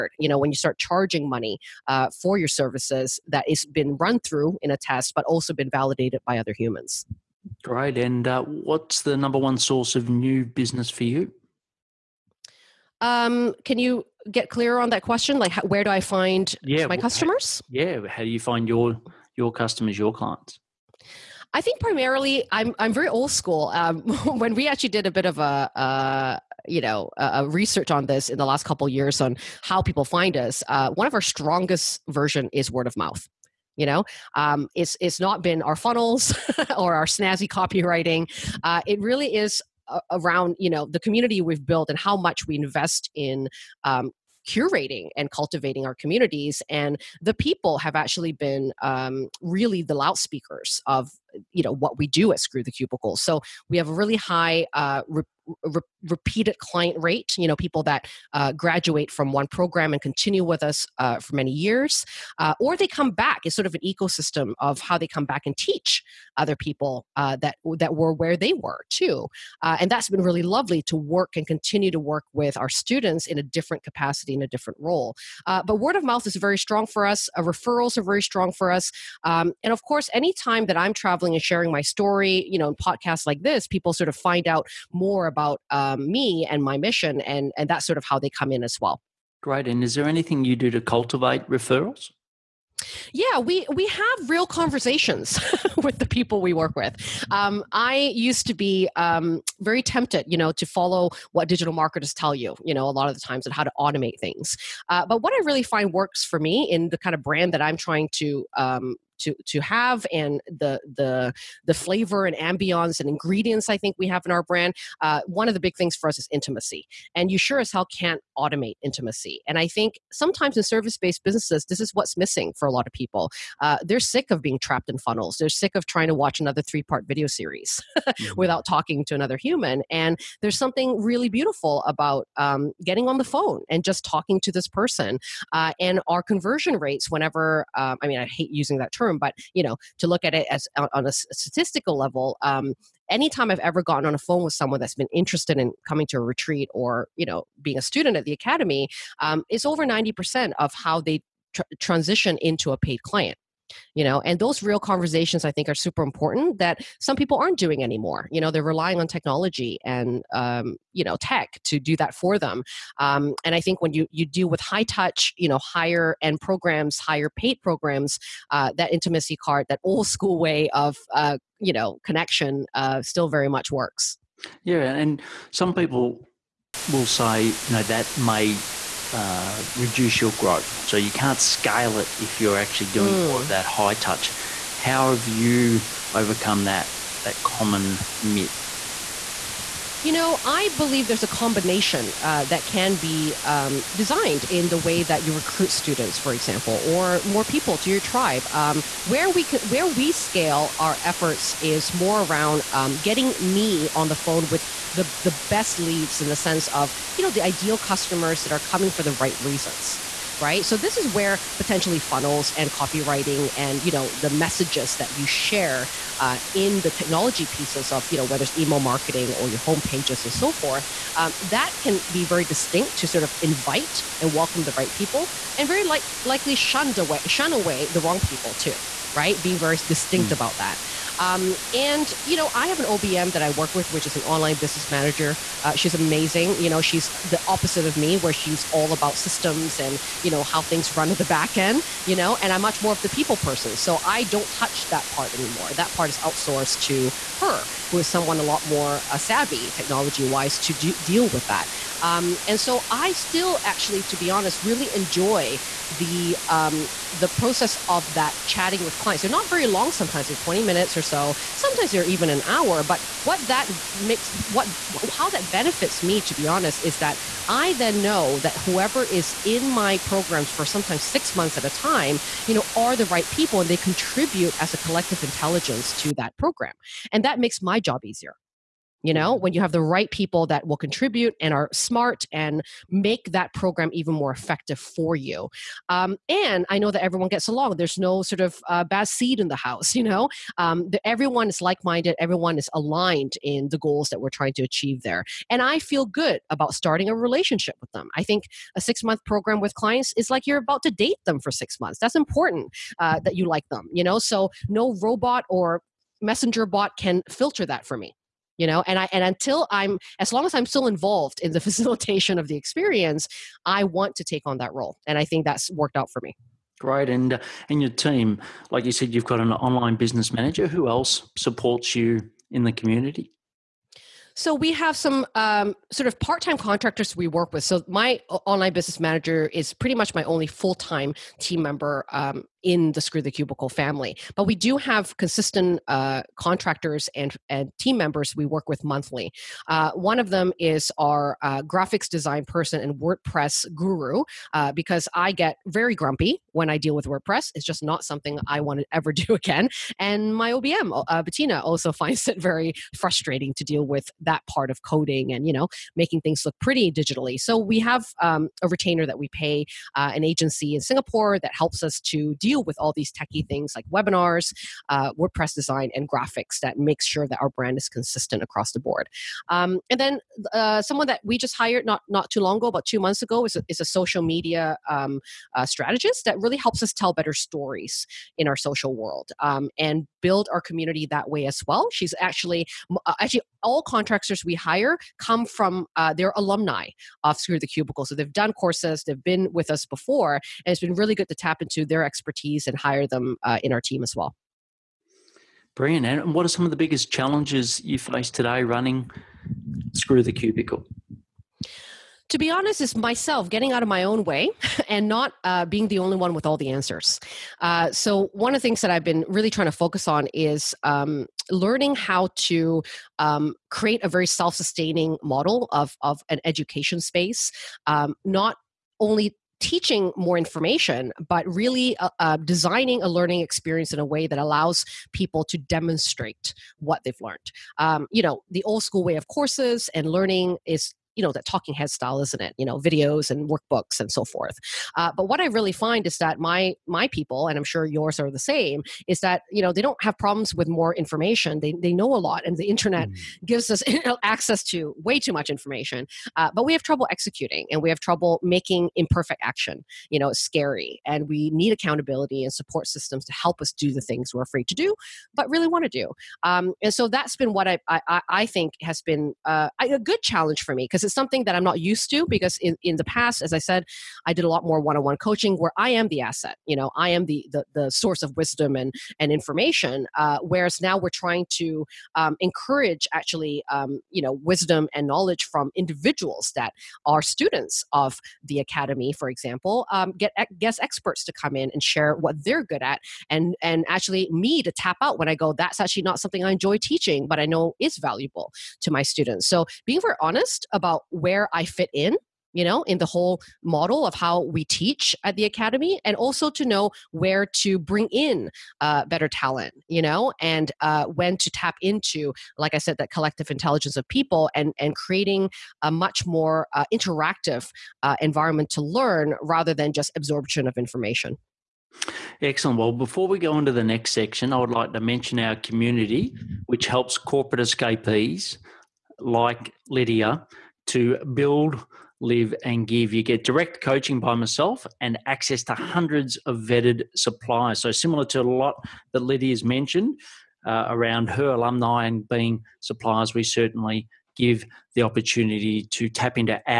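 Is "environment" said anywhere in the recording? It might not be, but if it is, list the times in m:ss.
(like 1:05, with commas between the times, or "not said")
8:28.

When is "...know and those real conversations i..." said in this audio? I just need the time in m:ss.
2:34.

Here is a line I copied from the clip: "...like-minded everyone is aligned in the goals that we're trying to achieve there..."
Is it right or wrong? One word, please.
right.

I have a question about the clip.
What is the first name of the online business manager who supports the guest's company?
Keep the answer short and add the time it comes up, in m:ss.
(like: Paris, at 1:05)
Bettina, at 5:51.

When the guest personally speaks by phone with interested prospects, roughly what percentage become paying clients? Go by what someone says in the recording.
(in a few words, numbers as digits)
Over 90 percent.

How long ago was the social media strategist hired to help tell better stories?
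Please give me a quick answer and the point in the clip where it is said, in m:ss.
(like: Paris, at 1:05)
About two months, at 6:12.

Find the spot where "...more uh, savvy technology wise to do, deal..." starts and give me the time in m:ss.
4:08.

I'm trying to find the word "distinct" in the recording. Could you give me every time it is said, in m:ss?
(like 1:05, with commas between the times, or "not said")
3:42, 3:49.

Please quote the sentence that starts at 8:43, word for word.
You get direct coaching by myself and access to hundreds of vetted suppliers.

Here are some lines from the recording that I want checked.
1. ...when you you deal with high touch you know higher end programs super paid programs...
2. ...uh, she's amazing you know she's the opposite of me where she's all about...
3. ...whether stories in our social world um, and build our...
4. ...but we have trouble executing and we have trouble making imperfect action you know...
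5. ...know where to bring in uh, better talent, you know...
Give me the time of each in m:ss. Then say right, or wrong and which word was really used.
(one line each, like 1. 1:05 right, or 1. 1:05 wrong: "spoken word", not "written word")
1. 2:43 wrong: "higher", not "super"
2. 3:55 right
3. 6:17 wrong: "better", not "whether"
4. 7:26 right
5. 8:16 right.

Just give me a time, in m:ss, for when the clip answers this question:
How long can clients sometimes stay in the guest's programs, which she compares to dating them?
4:31.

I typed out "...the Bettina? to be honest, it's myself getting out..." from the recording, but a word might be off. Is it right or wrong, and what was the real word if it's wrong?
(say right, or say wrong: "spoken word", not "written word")
wrong: "Cubicle", not "Bettina".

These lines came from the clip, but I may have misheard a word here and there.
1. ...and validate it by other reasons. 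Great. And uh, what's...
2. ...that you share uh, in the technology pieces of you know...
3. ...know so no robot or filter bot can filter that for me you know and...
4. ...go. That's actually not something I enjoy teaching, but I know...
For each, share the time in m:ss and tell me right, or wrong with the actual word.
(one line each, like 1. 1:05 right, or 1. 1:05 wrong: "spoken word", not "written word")
1. 0:05 wrong: "humans", not "reasons"
2. 3:34 right
3. 5:04 wrong: "messenger", not "filter"
4. 8:05 right.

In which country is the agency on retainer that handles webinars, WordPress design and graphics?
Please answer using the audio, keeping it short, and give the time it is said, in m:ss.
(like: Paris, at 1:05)
Singapore, at 6:00.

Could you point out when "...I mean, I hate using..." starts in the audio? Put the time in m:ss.
2:18.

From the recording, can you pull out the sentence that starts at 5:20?
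Who else supports you in the community?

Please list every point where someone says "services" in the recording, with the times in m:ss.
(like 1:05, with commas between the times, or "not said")
0:02, 2:00.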